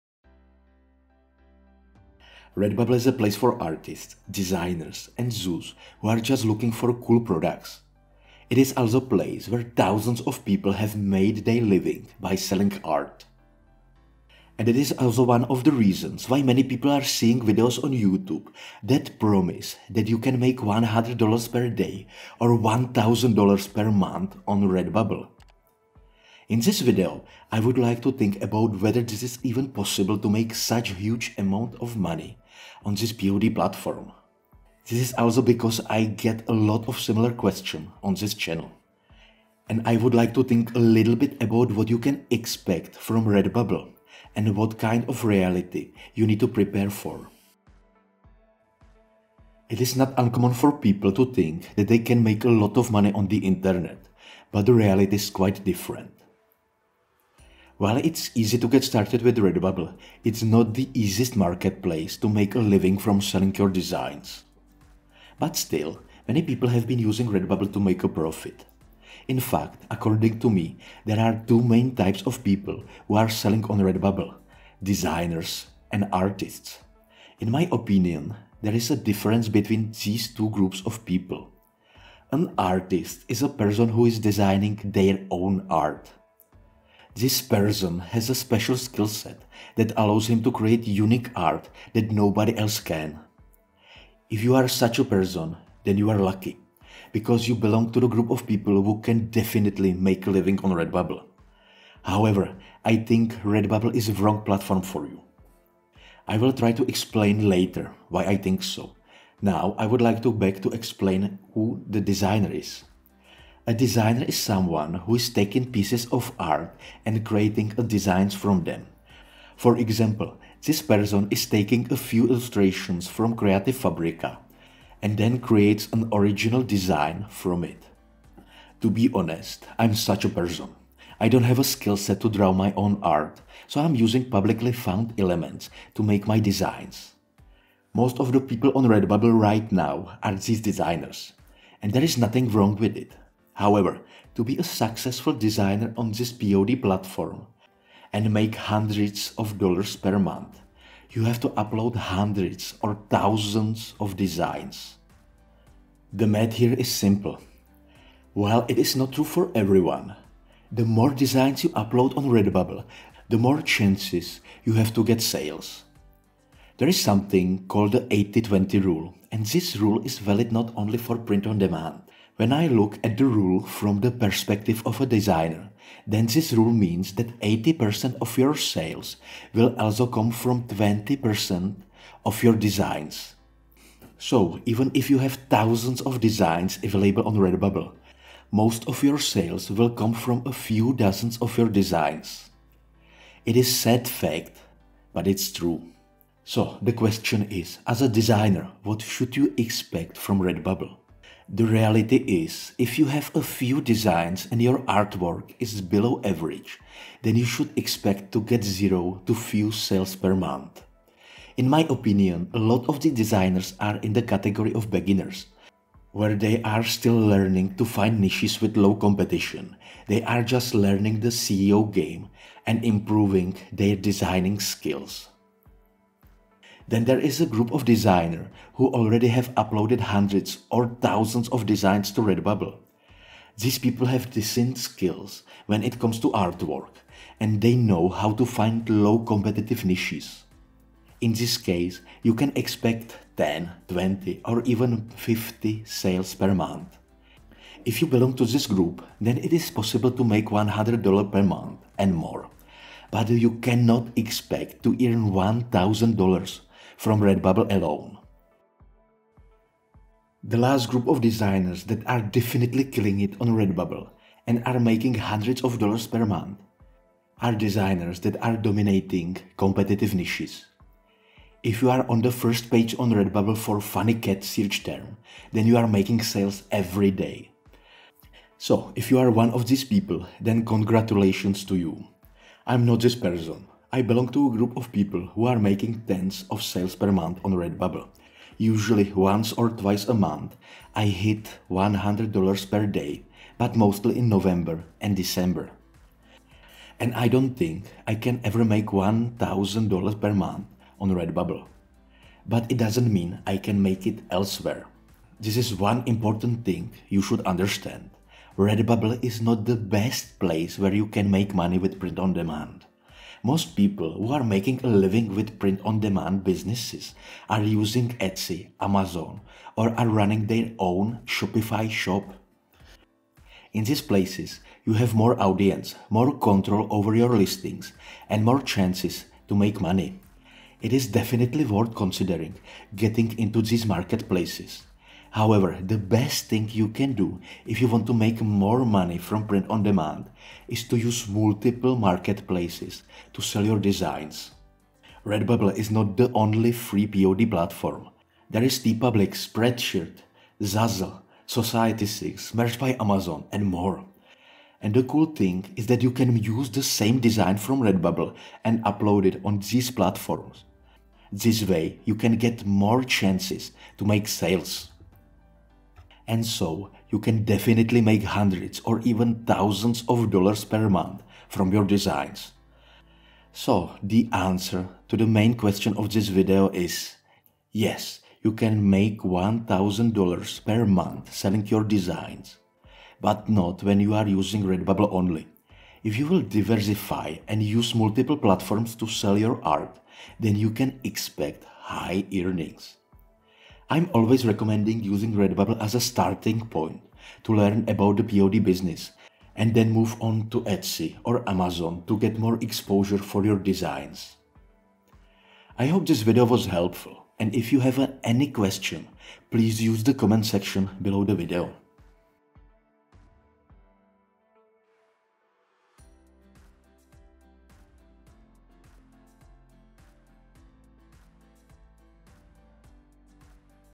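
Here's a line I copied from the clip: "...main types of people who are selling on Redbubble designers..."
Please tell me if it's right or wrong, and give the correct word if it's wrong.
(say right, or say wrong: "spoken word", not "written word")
right.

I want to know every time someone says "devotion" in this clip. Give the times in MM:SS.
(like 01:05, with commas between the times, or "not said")
not said.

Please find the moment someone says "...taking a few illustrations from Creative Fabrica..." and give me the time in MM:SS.
02:01.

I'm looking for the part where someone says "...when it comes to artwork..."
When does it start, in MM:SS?
03:55.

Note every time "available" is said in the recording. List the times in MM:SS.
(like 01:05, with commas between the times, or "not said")
03:06.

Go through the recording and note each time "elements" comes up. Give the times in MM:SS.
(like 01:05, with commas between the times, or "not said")
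02:15.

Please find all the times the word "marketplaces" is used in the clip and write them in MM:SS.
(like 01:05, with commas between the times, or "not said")
01:01, 05:33, 05:41.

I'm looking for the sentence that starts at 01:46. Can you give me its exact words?
I will try to explain later why I think so.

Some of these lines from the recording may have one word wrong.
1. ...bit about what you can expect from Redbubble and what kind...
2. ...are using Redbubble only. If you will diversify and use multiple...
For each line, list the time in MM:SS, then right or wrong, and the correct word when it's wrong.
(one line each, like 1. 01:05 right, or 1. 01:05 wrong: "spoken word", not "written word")
1. 00:41 right
2. 06:24 right.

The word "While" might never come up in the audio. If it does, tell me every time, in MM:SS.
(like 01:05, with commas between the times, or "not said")
00:57, 02:38.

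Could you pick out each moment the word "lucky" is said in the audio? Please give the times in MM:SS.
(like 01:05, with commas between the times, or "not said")
01:36.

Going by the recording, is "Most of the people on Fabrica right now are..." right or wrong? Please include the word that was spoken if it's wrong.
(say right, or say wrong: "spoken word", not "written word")
wrong: "Redbubble", not "Fabrica".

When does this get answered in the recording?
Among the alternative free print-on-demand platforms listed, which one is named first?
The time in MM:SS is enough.
05:48.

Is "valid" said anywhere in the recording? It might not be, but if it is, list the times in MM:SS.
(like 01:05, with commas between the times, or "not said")
02:50.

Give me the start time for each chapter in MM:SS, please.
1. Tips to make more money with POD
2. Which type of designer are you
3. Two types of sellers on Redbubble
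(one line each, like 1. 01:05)
1. 05:08
2. 02:42
3. 01:10.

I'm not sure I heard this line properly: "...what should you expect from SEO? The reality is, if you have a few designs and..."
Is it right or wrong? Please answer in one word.
wrong.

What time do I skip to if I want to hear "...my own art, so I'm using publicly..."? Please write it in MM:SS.
02:12.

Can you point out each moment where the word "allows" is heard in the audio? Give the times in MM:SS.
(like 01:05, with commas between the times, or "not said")
01:29.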